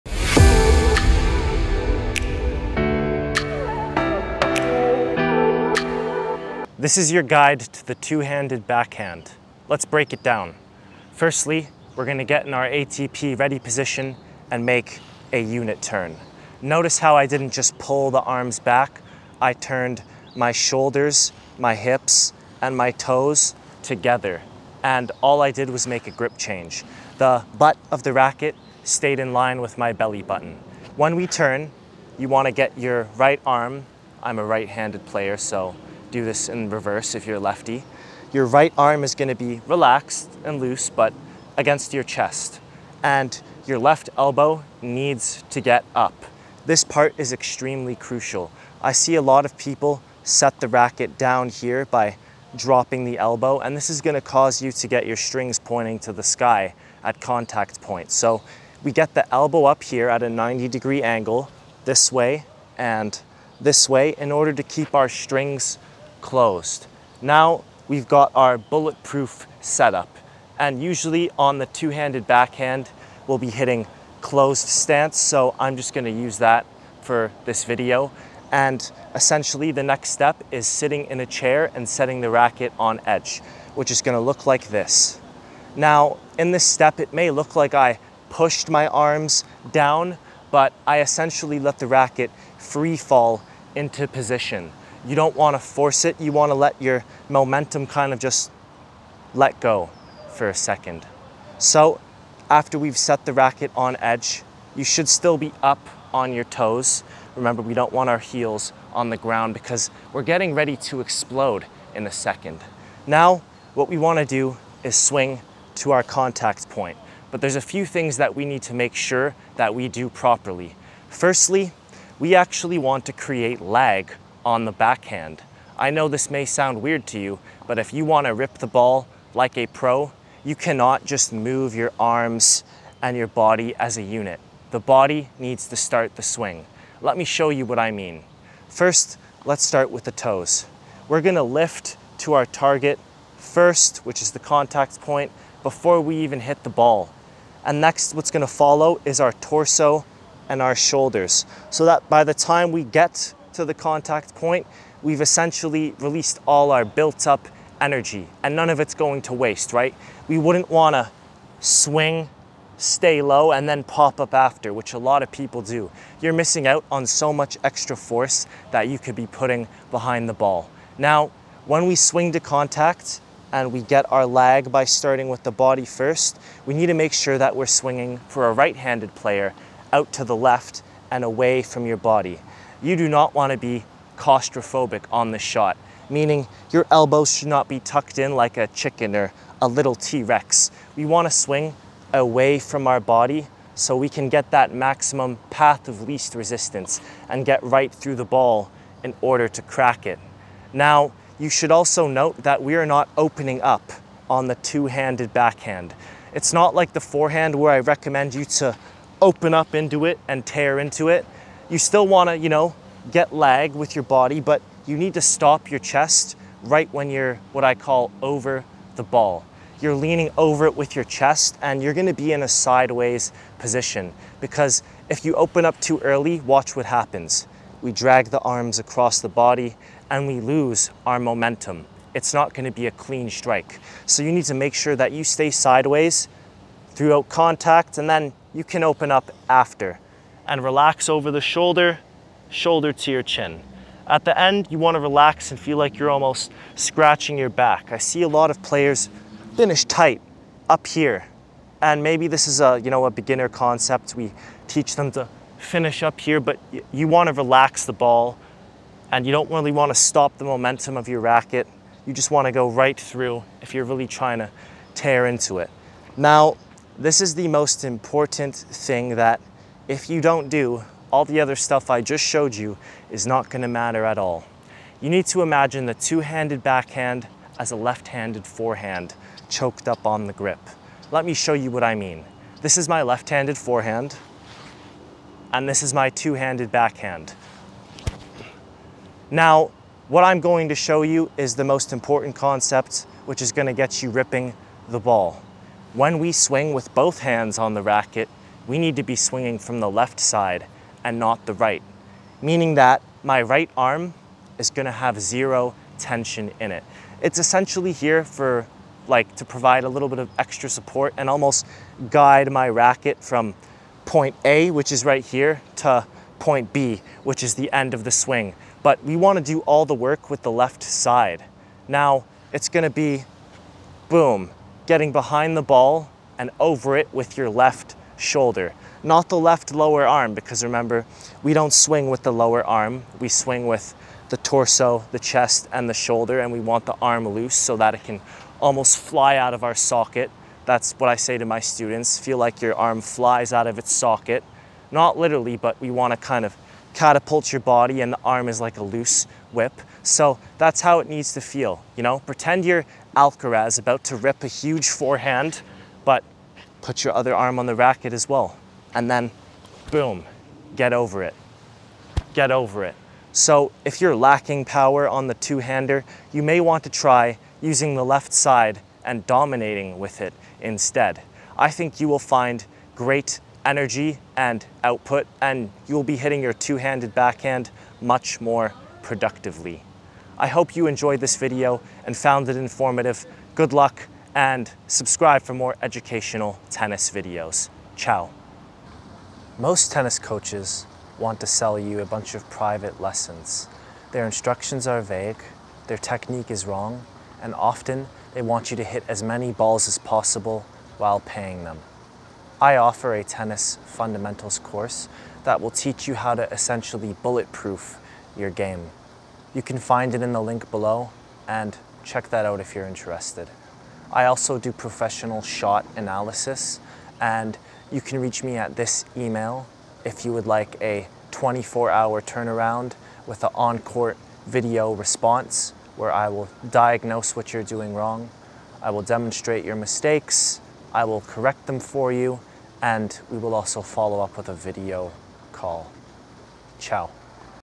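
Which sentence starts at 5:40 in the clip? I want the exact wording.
That's what I say to my students, feel like your arm flies out of its socket.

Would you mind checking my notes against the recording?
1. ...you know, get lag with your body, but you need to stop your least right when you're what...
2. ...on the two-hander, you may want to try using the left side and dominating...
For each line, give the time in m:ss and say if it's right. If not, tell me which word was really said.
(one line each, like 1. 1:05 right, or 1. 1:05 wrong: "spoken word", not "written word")
1. 3:32 wrong: "chest", not "least"
2. 6:05 right.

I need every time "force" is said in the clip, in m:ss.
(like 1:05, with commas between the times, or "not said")
1:35, 2:47.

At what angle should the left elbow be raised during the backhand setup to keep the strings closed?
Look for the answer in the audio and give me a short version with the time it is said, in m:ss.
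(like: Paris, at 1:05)
90 degrees, at 1:00.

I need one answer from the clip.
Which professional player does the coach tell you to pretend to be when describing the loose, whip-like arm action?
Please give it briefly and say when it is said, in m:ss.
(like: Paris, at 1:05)
Alcaraz, at 5:53.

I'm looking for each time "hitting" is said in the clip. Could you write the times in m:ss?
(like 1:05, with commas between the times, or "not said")
1:13, 6:16.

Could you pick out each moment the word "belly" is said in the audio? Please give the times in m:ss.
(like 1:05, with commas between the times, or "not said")
0:29.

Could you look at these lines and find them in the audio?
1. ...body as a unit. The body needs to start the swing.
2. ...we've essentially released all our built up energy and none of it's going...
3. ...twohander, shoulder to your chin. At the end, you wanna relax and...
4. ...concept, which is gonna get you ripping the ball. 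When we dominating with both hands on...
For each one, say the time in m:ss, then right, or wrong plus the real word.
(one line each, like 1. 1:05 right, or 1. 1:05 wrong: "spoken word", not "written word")
1. 2:13 right
2. 2:35 right
3. 4:01 wrong: "shoulder", not "twohander"
4. 4:52 wrong: "swing", not "dominating".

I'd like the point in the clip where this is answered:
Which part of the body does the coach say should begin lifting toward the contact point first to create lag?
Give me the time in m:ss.
2:20.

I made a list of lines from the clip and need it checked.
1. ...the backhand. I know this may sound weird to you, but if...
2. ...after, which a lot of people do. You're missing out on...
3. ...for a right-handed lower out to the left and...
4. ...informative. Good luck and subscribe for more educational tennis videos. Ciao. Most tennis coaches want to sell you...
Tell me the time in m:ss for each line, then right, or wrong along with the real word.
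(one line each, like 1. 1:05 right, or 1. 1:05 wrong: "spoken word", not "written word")
1. 2:04 right
2. 2:44 right
3. 2:58 wrong: "player", not "lower"
4. 6:22 right.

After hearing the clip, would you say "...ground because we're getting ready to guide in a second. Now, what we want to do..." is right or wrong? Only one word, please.
wrong.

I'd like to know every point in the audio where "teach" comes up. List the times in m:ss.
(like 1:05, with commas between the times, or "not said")
4:14, 6:45.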